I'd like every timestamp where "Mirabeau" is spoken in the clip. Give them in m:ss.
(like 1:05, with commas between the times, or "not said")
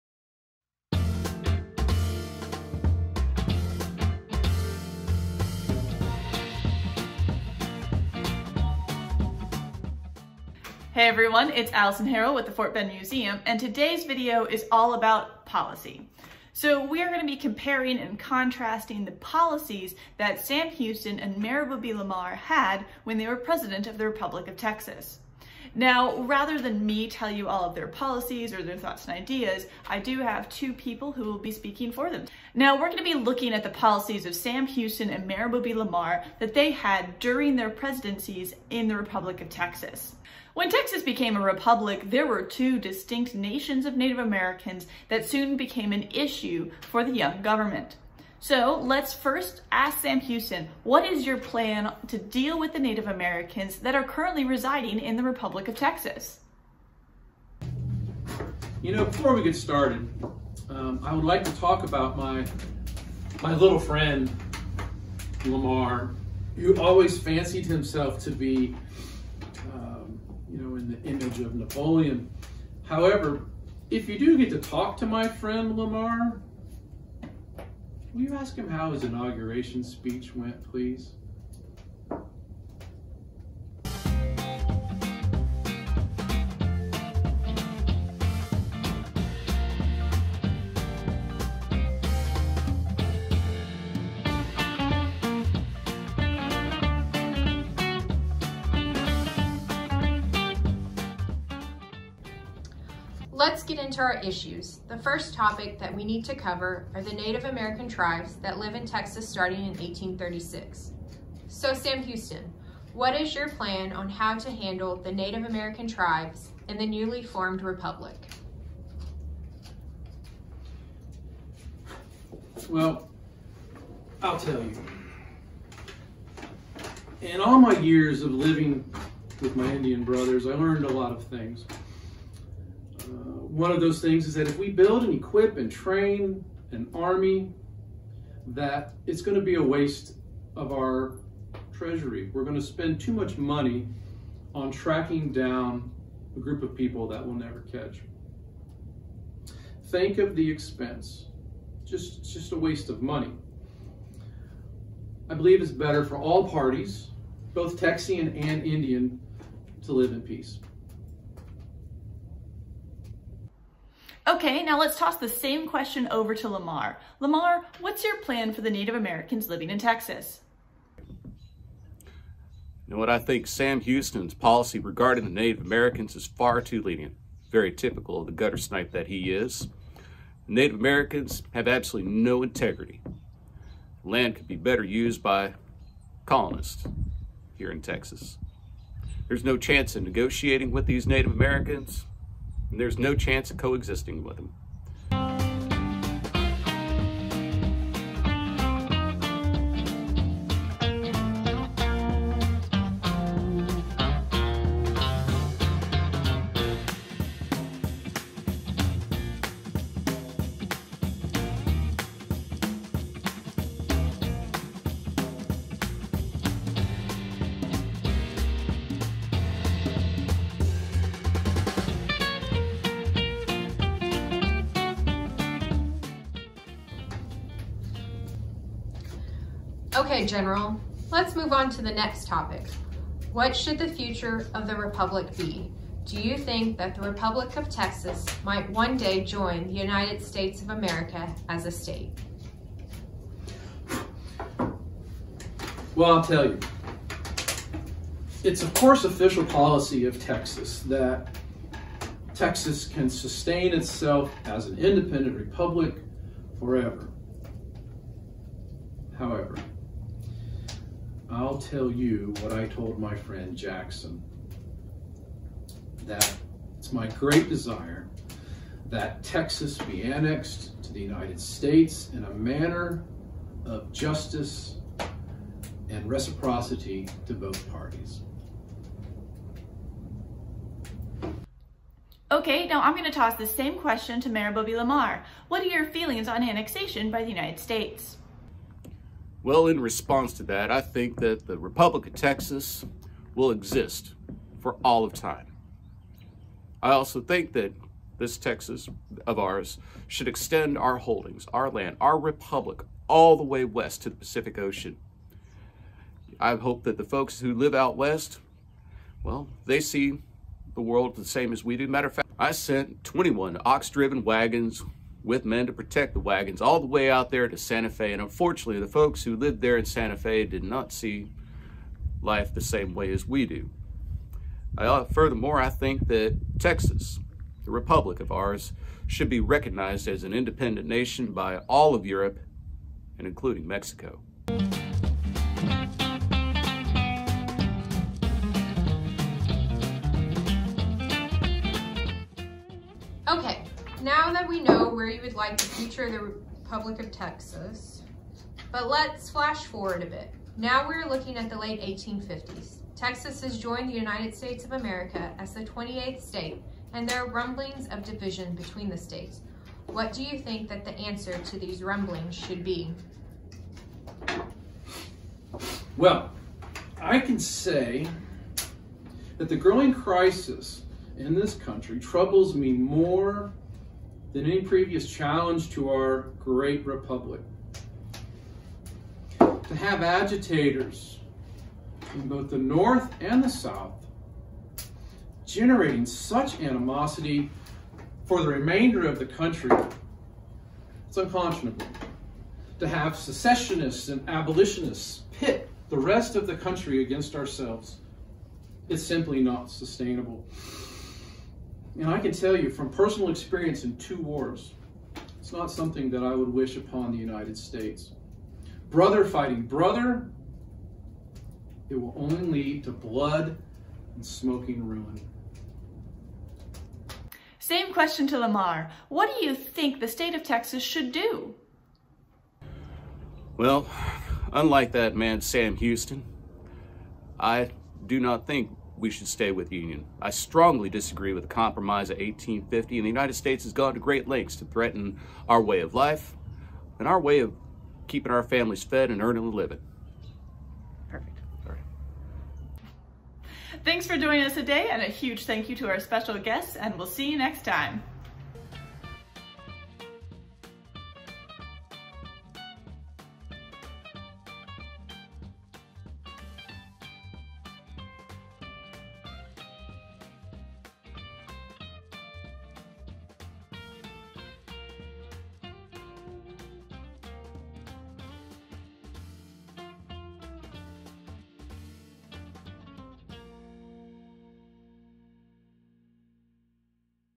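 0:21, 0:35, 4:44.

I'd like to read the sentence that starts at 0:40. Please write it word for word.
When Texas became a republic, there were two distinct nations of Native Americans that soon became an issue for the young government.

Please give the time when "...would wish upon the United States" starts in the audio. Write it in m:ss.
6:46.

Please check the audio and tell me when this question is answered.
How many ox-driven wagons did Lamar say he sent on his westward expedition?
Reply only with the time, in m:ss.
5:13.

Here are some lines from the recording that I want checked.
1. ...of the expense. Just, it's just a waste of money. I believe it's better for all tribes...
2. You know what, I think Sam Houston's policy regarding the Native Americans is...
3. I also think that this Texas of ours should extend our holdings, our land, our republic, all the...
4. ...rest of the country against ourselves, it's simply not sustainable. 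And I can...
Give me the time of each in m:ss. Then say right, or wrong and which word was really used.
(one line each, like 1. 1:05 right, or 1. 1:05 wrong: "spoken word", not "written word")
1. 2:30 wrong: "parties", not "tribes"
2. 2:51 right
3. 4:56 right
4. 6:35 right.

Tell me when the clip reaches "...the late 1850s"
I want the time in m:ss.
5:51.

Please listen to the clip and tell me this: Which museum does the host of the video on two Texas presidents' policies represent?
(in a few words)
Fort Bend Museum.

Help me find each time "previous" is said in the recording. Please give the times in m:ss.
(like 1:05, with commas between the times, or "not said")
6:14.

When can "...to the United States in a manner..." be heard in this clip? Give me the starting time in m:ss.
4:30.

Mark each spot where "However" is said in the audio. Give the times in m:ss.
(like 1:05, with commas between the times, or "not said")
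1:12, 4:19.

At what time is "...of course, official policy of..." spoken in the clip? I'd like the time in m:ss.
4:08.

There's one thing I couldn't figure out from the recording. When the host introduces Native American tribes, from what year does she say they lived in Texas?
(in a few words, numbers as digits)
1836.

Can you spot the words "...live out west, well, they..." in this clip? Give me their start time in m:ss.
5:07.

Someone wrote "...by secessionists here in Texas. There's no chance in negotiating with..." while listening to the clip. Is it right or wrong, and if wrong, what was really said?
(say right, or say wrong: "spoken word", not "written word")
wrong: "colonists", not "secessionists".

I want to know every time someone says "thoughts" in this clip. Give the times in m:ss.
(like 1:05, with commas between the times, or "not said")
0:28.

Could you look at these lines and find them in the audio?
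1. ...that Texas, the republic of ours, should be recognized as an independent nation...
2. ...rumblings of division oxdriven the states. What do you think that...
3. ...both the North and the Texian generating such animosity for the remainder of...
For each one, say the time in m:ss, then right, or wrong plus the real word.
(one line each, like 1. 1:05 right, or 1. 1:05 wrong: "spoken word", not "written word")
1. 5:26 right
2. 5:57 wrong: "between", not "oxdriven"
3. 6:22 wrong: "South", not "Texian".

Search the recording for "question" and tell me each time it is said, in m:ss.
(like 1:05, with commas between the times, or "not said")
2:45, 4:43, 6:57.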